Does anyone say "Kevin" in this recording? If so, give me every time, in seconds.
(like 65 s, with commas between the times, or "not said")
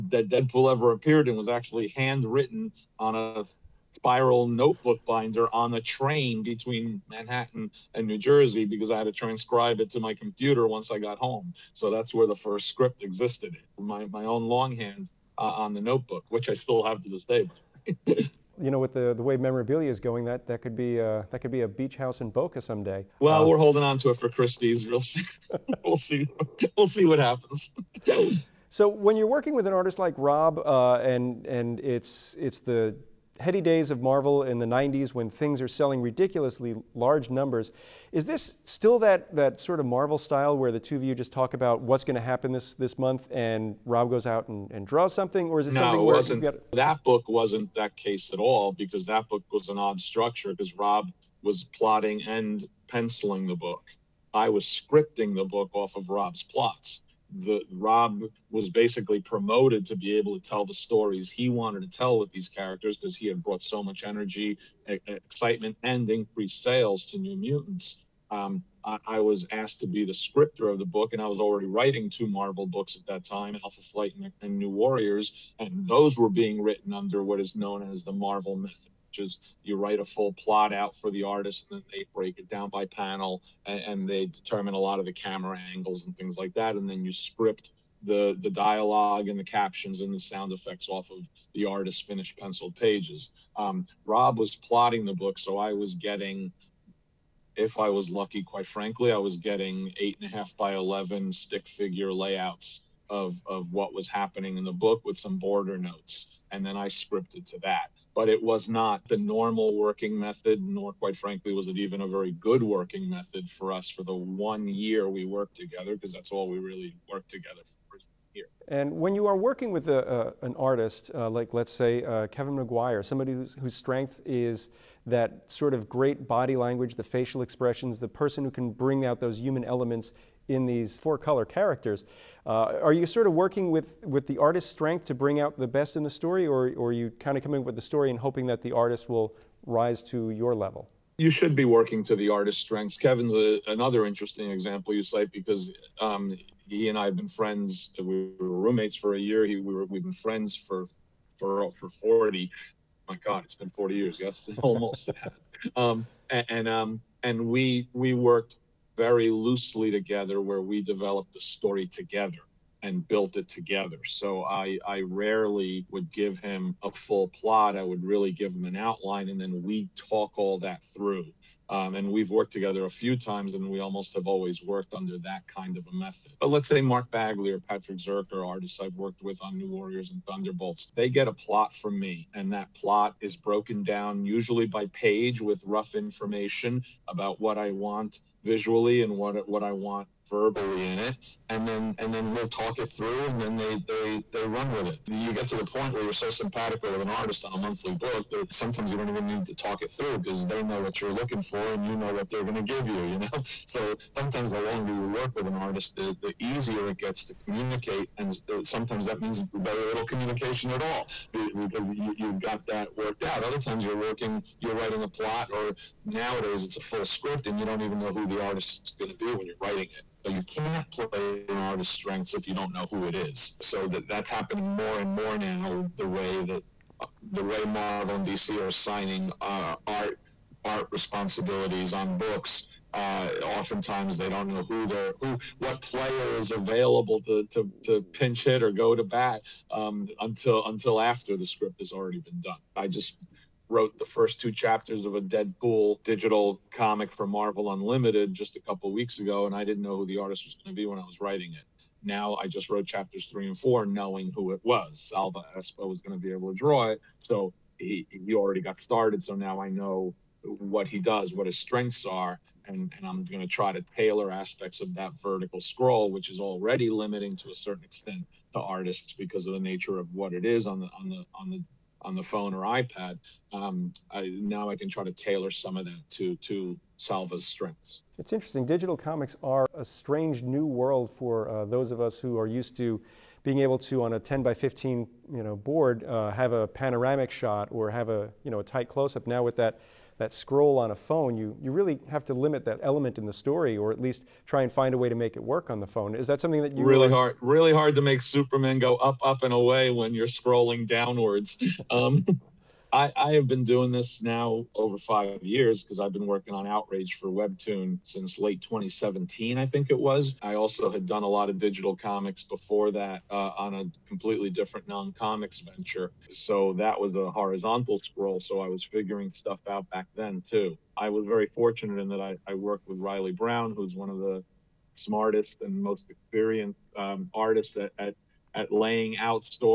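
122 s, 142 s.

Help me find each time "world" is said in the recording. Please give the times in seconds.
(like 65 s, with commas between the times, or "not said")
280 s.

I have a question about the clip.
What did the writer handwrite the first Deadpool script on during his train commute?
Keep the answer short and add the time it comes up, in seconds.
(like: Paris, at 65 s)
Spiral notebook, at 3 s.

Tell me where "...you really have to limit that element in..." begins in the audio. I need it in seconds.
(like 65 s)
291 s.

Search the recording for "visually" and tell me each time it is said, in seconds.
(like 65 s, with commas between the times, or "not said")
188 s.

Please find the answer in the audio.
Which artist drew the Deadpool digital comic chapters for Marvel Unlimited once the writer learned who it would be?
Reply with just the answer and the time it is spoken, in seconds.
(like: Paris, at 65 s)
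Salva Espin, at 254 s.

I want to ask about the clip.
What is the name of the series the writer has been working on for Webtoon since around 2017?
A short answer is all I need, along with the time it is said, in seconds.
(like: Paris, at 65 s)
Outrage, at 306 s.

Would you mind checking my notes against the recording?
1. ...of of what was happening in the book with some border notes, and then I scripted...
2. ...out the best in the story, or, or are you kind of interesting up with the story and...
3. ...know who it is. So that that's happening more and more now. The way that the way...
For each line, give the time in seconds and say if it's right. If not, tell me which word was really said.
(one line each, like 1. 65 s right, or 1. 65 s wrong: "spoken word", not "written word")
1. 103 s right
2. 135 s wrong: "coming", not "interesting"
3. 222 s right.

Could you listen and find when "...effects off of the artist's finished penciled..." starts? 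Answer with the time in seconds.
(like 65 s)
90 s.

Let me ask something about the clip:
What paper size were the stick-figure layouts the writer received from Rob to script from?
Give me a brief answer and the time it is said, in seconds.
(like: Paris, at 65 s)
8.5 by 11, at 99 s.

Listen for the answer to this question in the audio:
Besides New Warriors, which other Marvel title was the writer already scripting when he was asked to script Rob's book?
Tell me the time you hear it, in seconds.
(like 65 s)
73 s.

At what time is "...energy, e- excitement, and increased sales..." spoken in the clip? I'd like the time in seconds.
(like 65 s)
64 s.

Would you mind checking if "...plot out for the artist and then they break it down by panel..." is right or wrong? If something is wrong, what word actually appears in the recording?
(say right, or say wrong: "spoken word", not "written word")
right.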